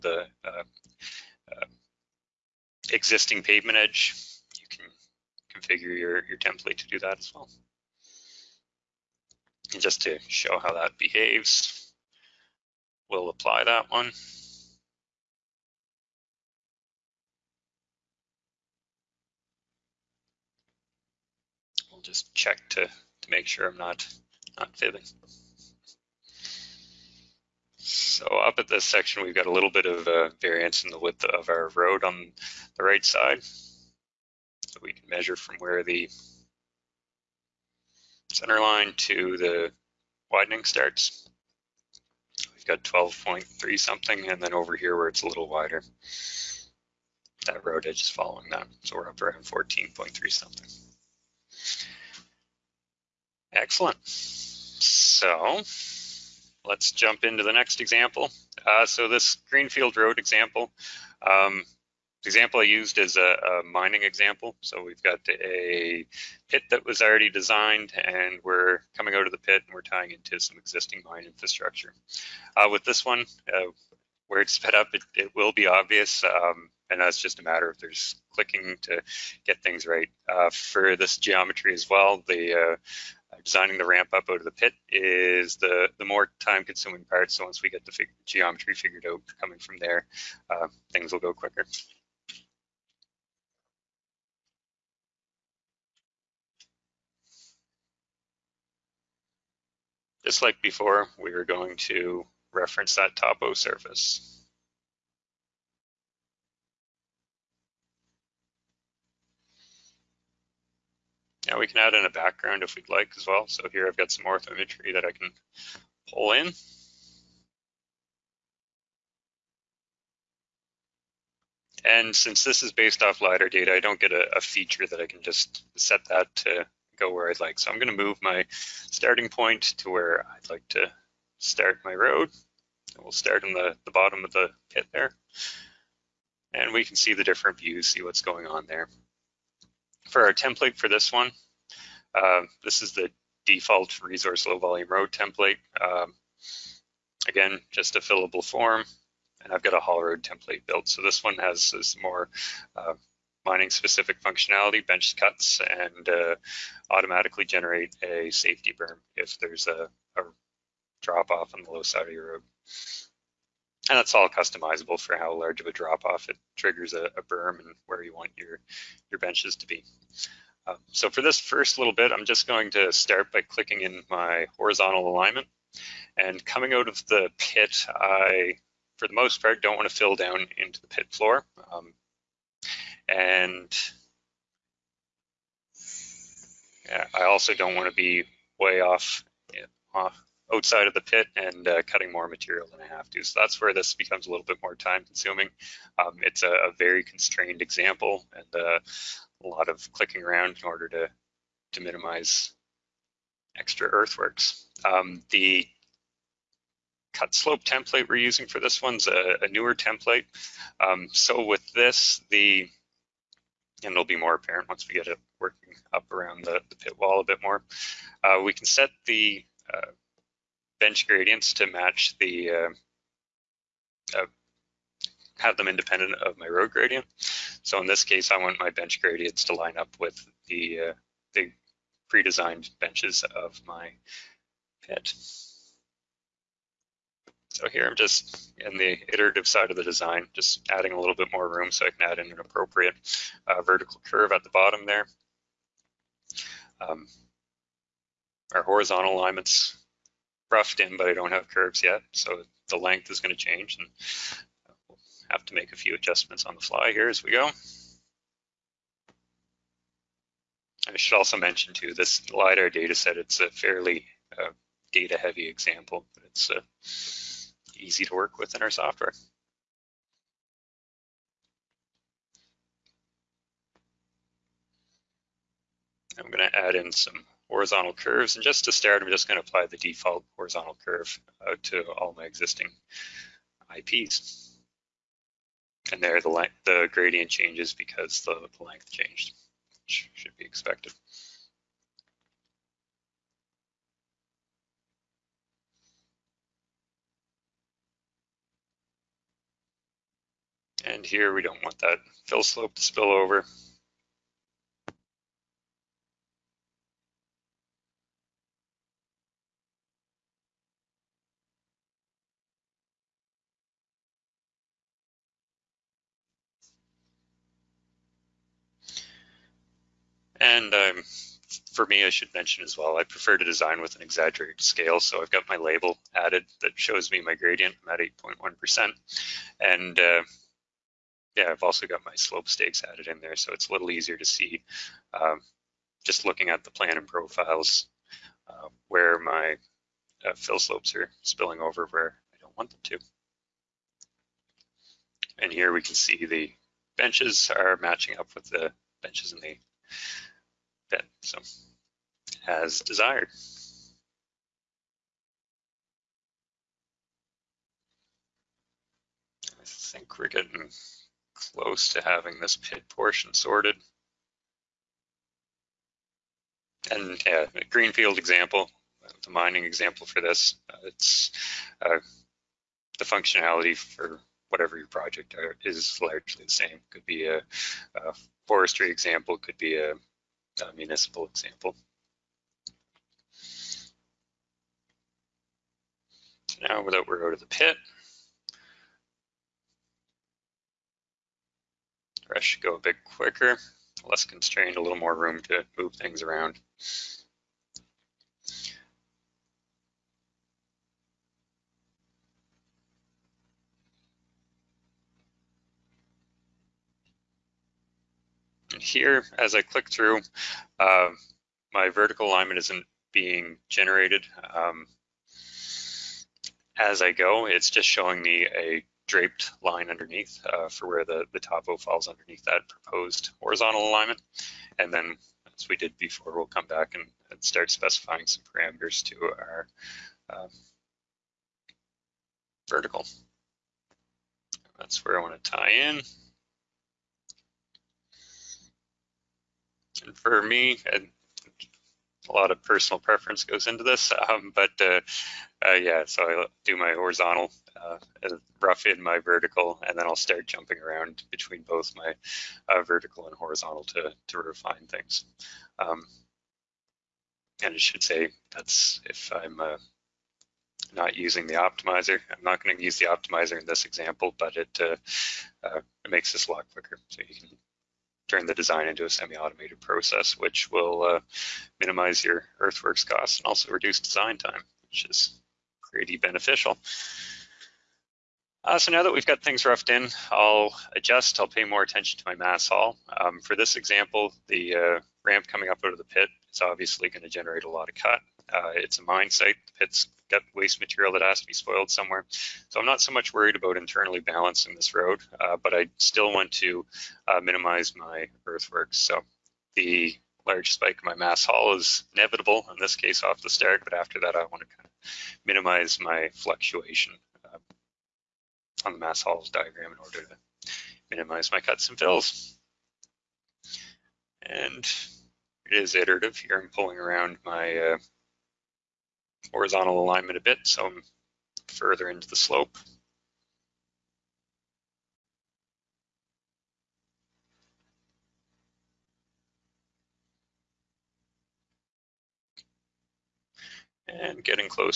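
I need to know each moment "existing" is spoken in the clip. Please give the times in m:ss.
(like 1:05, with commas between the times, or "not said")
0:02, 1:10, 4:42.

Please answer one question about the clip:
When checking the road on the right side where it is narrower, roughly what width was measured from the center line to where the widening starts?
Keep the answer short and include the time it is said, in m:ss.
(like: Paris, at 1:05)
12.3, at 0:42.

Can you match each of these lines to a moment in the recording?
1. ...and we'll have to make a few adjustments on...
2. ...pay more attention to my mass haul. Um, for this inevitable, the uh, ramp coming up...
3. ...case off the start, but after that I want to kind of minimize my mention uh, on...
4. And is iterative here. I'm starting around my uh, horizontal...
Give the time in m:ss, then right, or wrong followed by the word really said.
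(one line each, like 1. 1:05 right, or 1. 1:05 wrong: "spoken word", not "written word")
1. 4:13 right
2. 8:01 wrong: "example", not "inevitable"
3. 8:22 wrong: "fluctuation", not "mention"
4. 8:34 wrong: "pulling", not "starting".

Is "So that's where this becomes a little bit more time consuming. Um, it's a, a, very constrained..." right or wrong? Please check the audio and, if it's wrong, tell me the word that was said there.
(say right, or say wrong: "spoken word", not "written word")
right.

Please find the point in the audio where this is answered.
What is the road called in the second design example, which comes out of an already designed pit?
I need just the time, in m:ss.
0:59.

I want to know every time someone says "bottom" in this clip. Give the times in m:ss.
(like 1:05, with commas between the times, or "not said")
2:13, 4:04.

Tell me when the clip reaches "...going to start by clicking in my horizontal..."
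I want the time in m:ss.
2:52.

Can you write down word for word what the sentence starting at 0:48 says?
So we're up around 14.3 something.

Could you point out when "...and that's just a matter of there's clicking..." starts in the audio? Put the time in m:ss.
1:16.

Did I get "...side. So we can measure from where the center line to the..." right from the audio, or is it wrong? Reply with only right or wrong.
right.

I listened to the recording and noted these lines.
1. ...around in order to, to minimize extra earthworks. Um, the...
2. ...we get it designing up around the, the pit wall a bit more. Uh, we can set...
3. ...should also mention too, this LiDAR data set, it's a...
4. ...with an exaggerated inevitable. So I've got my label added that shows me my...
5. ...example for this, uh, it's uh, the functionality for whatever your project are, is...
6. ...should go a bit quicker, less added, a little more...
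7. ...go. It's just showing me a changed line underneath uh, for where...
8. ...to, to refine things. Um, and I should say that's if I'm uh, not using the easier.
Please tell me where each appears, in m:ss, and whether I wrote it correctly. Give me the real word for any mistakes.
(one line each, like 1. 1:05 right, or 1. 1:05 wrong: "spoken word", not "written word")
1. 3:20 right
2. 3:34 wrong: "working", not "designing"
3. 4:20 right
4. 5:23 wrong: "scale", not "inevitable"
5. 6:09 right
6. 6:32 wrong: "constrained", not "added"
7. 6:57 wrong: "draped", not "changed"
8. 7:33 wrong: "optimizer", not "easier".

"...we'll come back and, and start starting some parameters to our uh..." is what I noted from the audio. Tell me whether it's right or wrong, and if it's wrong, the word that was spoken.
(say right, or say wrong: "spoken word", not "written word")
wrong: "specifying", not "starting".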